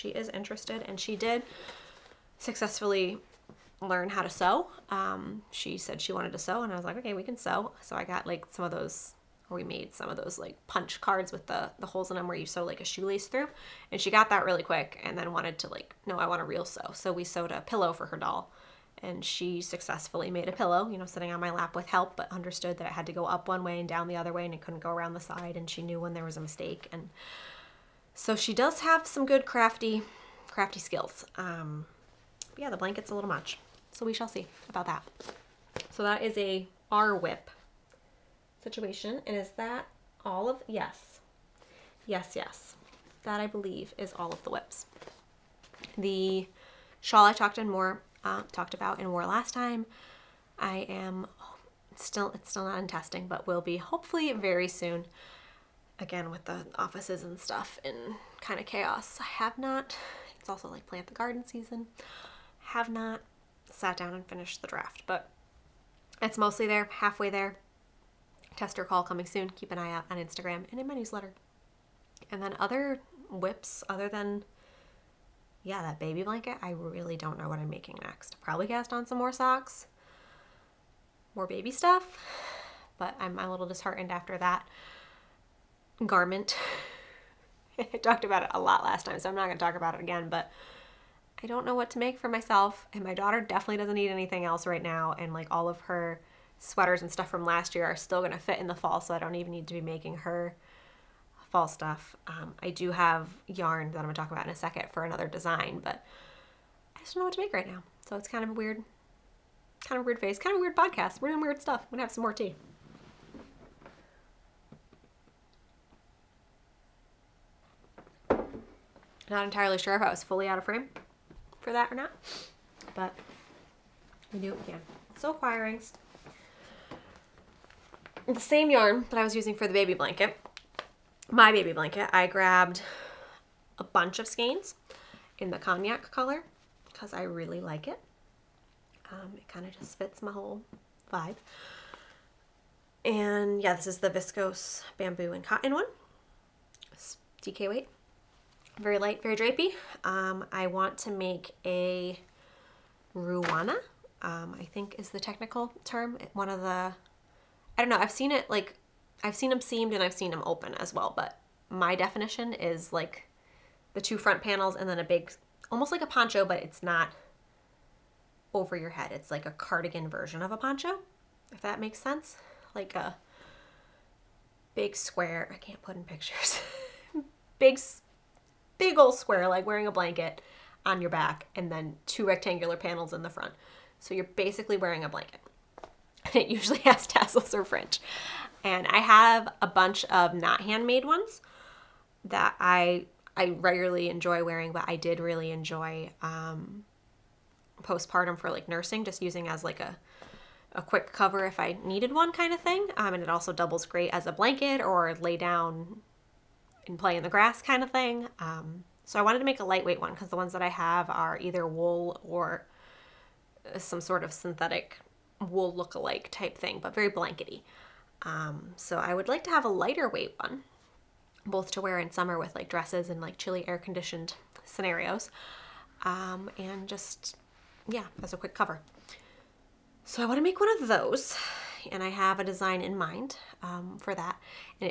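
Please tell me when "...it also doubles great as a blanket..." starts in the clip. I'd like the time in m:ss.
3:23.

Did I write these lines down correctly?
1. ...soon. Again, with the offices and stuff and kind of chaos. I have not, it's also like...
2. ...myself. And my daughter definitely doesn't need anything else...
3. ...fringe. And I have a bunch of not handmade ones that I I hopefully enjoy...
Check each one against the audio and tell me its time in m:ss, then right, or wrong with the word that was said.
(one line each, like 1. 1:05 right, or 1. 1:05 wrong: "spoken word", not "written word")
1. 0:54 right
2. 1:32 right
3. 3:07 wrong: "regularly", not "hopefully".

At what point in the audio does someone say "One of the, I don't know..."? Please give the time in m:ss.
2:36.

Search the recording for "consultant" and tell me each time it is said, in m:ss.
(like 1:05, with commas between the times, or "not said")
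not said.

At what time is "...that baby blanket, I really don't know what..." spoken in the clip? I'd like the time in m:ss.
1:15.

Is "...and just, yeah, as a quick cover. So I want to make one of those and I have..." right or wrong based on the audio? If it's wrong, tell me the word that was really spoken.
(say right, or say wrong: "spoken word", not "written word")
right.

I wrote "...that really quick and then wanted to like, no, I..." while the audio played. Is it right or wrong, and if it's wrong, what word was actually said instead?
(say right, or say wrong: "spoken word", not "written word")
right.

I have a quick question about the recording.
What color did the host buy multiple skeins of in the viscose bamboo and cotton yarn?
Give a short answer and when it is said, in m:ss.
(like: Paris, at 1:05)
Cognac, at 2:15.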